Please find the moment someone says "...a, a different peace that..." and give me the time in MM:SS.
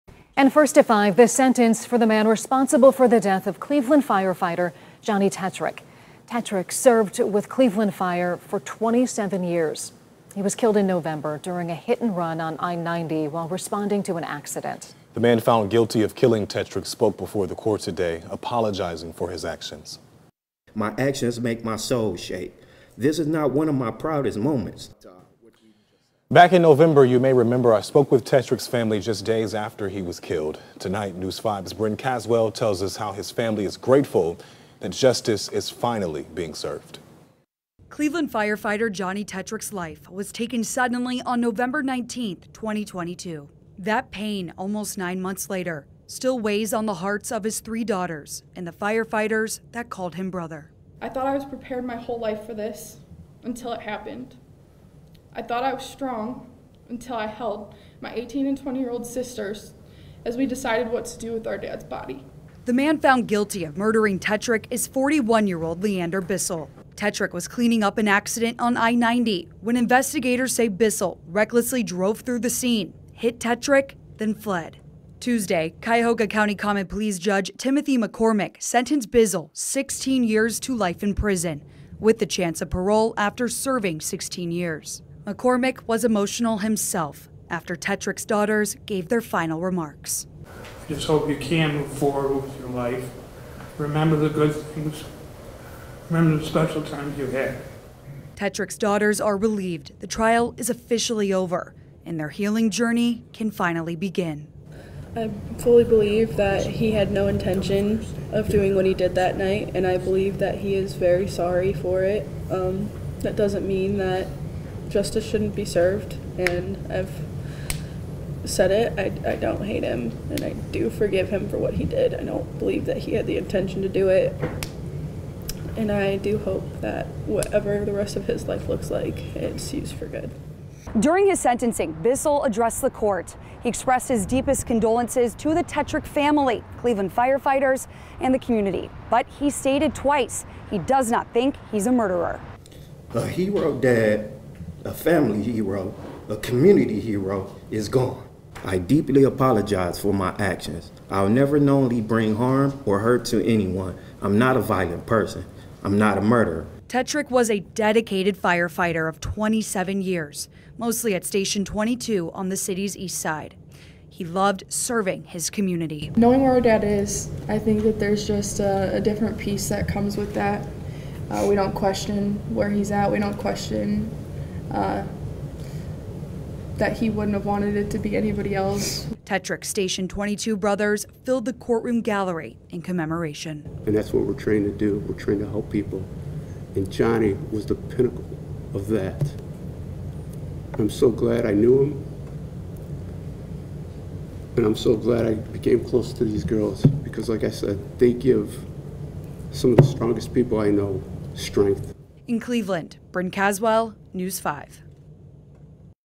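02:48.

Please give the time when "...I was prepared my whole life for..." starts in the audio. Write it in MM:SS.
00:51.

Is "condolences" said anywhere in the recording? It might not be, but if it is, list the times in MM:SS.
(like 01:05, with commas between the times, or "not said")
02:14.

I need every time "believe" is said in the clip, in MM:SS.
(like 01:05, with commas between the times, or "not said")
01:45, 01:49, 02:02.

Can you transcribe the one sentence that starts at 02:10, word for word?
During his sentencing, Bissell addressed the court.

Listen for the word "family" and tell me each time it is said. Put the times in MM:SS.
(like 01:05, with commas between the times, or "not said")
00:28, 00:33, 02:16, 02:24.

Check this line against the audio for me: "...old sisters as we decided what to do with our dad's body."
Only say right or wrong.
right.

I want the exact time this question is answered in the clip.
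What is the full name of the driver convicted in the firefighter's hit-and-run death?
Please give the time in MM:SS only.
01:05.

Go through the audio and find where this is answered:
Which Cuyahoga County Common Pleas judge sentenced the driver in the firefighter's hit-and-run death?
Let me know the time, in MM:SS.
01:17.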